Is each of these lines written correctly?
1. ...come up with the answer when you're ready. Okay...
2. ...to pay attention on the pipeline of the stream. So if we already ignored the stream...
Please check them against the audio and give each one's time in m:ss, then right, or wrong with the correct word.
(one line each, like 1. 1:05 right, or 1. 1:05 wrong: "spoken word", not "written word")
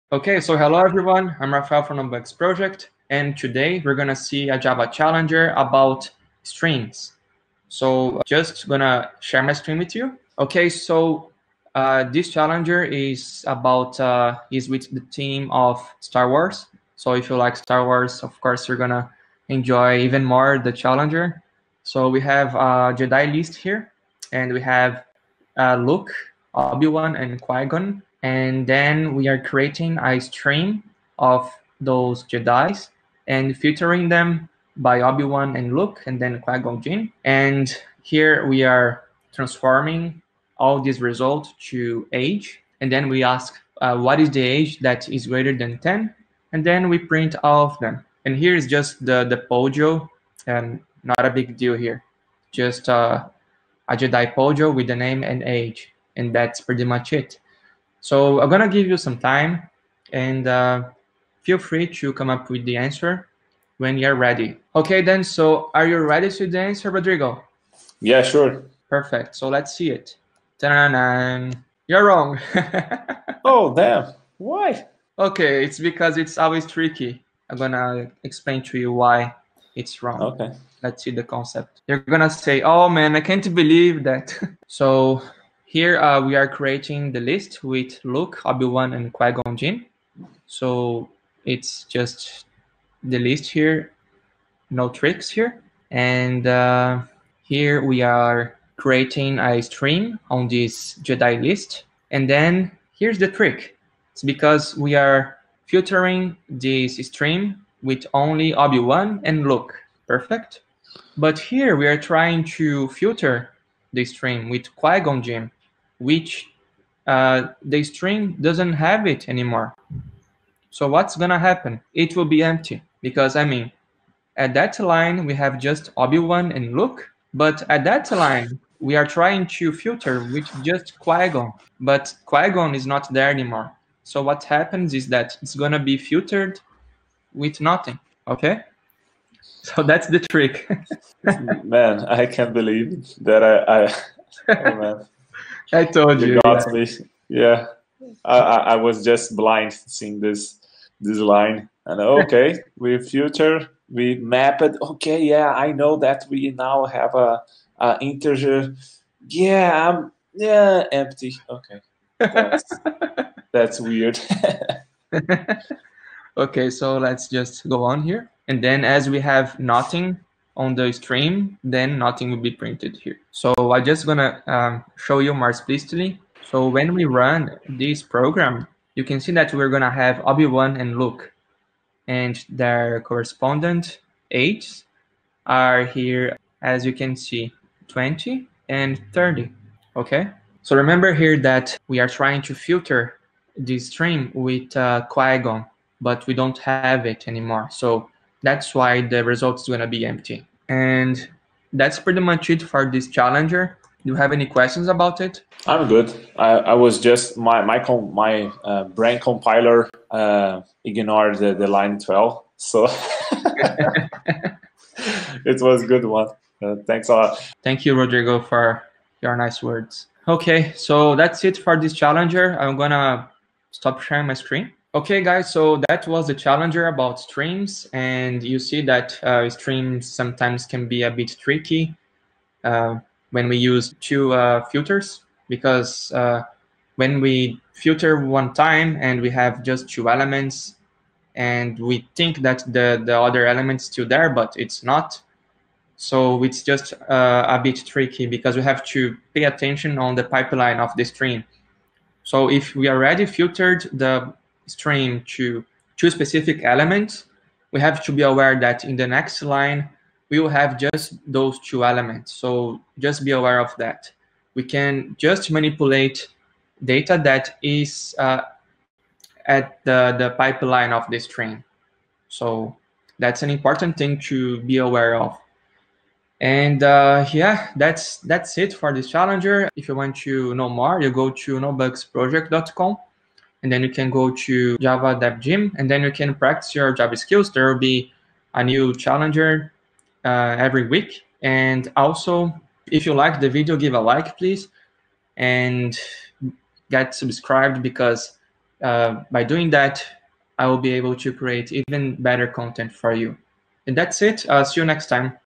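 1. 1:02 right
2. 4:08 wrong: "filtered", not "ignored".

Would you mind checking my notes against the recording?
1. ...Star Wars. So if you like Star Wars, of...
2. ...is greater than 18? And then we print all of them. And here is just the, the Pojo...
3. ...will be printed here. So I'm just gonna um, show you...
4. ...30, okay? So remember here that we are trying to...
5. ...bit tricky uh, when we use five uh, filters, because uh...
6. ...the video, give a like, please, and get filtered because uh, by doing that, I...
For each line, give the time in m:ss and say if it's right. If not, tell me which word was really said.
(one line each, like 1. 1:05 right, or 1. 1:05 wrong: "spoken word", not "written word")
1. 0:16 right
2. 0:45 wrong: "10", not "18"
3. 2:52 right
4. 3:09 right
5. 3:51 wrong: "two", not "five"
6. 4:53 wrong: "subscribed", not "filtered".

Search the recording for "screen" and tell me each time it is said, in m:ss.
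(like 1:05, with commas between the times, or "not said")
0:09, 3:44.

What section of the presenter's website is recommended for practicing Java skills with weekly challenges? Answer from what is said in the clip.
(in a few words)
Java Dev Gym.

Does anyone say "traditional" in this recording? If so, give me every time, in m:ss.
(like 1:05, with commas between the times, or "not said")
not said.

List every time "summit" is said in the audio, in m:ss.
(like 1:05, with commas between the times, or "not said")
not said.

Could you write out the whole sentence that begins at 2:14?
So what happens is that it's gonna be filtered with nothing, okay?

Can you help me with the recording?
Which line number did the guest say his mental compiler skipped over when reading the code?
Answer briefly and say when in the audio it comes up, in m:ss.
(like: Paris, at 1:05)
12, at 3:31.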